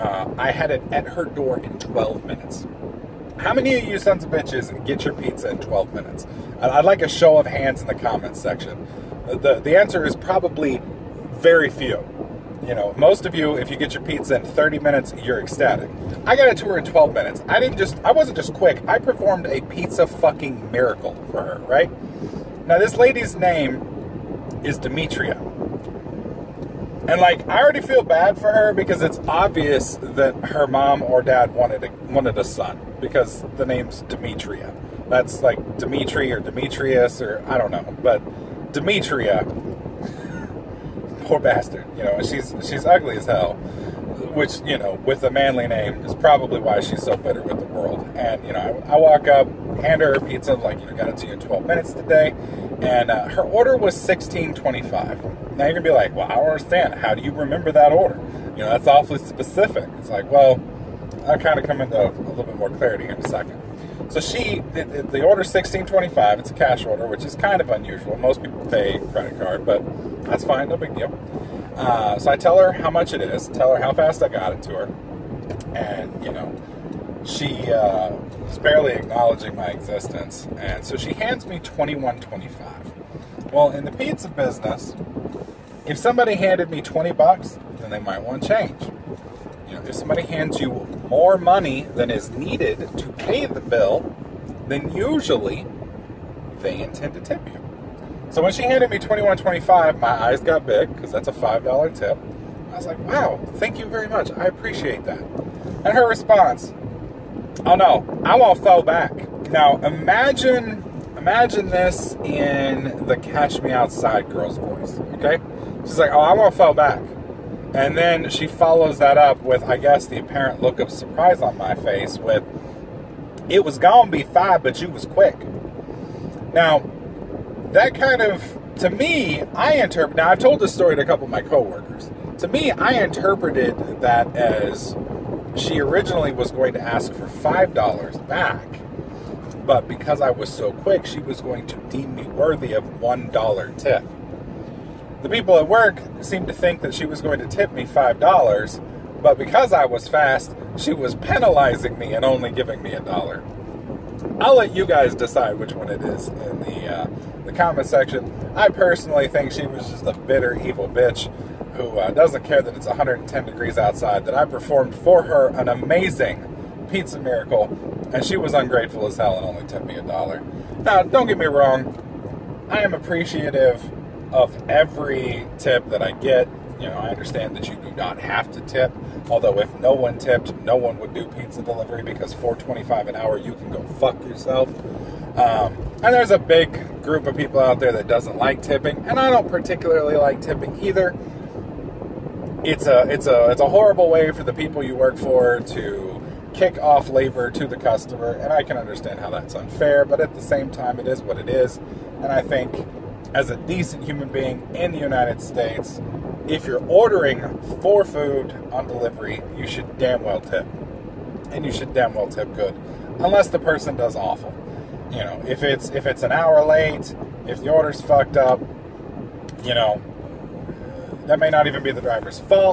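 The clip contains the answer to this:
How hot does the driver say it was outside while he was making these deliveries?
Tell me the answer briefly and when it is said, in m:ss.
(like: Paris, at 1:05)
110 degrees, at 2:42.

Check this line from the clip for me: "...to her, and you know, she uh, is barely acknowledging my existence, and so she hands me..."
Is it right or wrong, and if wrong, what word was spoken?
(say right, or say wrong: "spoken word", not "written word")
right.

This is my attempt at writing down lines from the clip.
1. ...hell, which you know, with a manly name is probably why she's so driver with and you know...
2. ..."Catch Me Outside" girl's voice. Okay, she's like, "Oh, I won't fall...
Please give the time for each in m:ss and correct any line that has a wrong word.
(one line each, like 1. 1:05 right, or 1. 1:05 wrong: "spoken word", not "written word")
1. 0:43 wrong: "bitter", not "driver"
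2. 1:53 right.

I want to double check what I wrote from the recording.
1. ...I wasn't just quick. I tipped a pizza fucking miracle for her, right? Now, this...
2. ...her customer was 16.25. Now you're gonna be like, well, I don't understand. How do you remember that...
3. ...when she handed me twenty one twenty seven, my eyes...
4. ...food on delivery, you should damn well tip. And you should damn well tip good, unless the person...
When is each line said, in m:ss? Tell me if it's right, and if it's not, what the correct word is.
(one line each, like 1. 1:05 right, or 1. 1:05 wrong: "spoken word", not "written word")
1. 0:17 wrong: "performed", not "tipped"
2. 0:53 wrong: "order", not "customer"
3. 1:38 wrong: "five", not "seven"
4. 3:28 right.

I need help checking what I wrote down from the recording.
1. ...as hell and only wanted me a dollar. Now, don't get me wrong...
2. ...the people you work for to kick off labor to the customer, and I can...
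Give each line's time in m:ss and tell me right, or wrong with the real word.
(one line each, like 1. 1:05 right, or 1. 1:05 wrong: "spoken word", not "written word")
1. 2:49 wrong: "tipped", not "wanted"
2. 3:14 right.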